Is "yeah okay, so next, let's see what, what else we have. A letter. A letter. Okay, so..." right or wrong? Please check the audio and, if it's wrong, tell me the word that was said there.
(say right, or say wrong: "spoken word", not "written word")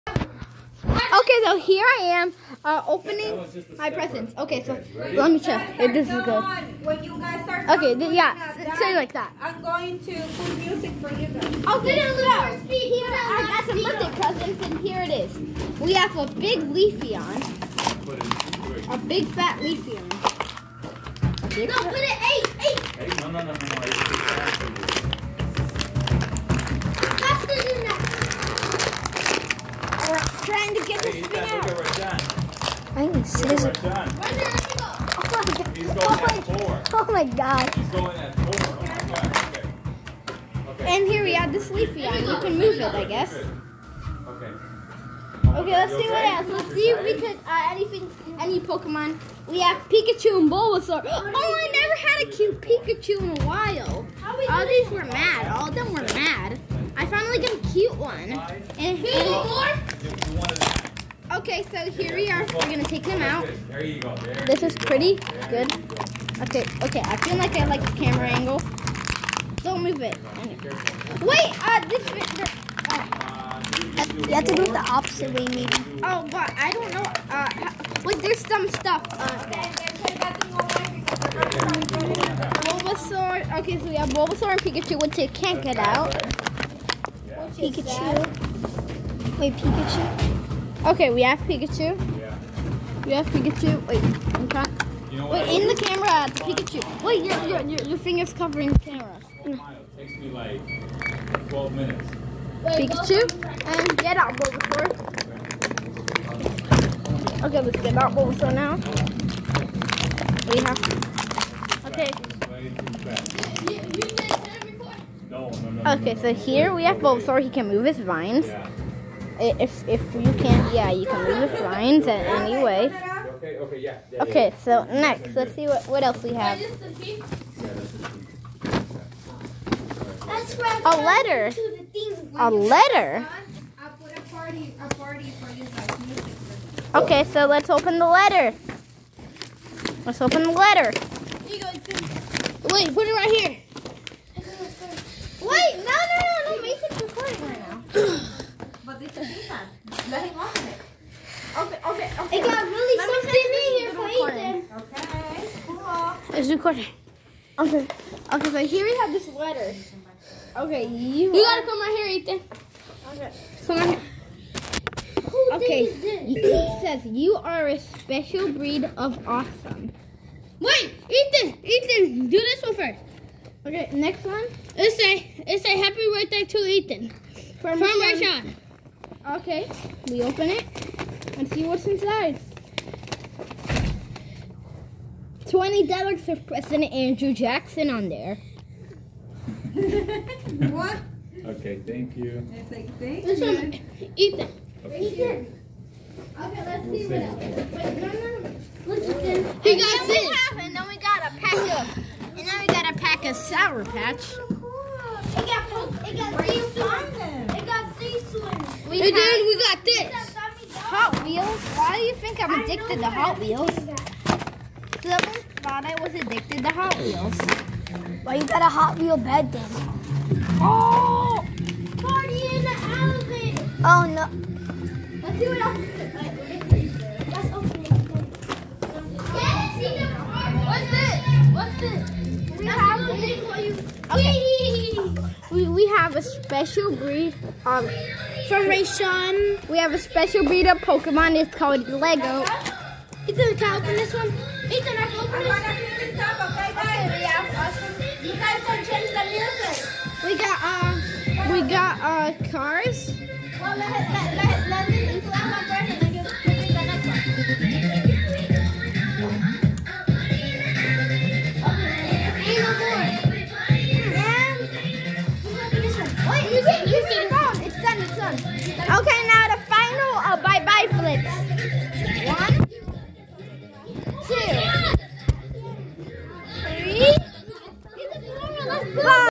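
right.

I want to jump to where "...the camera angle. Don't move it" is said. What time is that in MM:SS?
01:07.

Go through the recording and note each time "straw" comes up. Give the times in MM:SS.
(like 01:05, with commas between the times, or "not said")
not said.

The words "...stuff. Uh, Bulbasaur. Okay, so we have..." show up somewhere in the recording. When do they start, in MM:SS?
01:18.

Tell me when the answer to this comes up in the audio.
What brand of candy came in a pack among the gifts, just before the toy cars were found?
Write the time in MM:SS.
03:23.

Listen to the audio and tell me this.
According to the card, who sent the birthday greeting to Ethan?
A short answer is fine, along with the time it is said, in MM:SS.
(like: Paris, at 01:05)
Rashad, at 02:57.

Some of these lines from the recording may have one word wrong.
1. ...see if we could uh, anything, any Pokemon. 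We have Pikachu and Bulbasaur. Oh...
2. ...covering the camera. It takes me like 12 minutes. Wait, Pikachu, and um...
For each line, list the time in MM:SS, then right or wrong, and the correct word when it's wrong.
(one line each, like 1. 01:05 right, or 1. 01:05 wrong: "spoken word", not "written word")
1. 00:46 right
2. 01:38 right.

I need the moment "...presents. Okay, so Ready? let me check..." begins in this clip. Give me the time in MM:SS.
00:03.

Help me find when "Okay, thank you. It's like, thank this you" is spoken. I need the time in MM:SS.
03:11.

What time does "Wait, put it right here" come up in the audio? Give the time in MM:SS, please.
02:22.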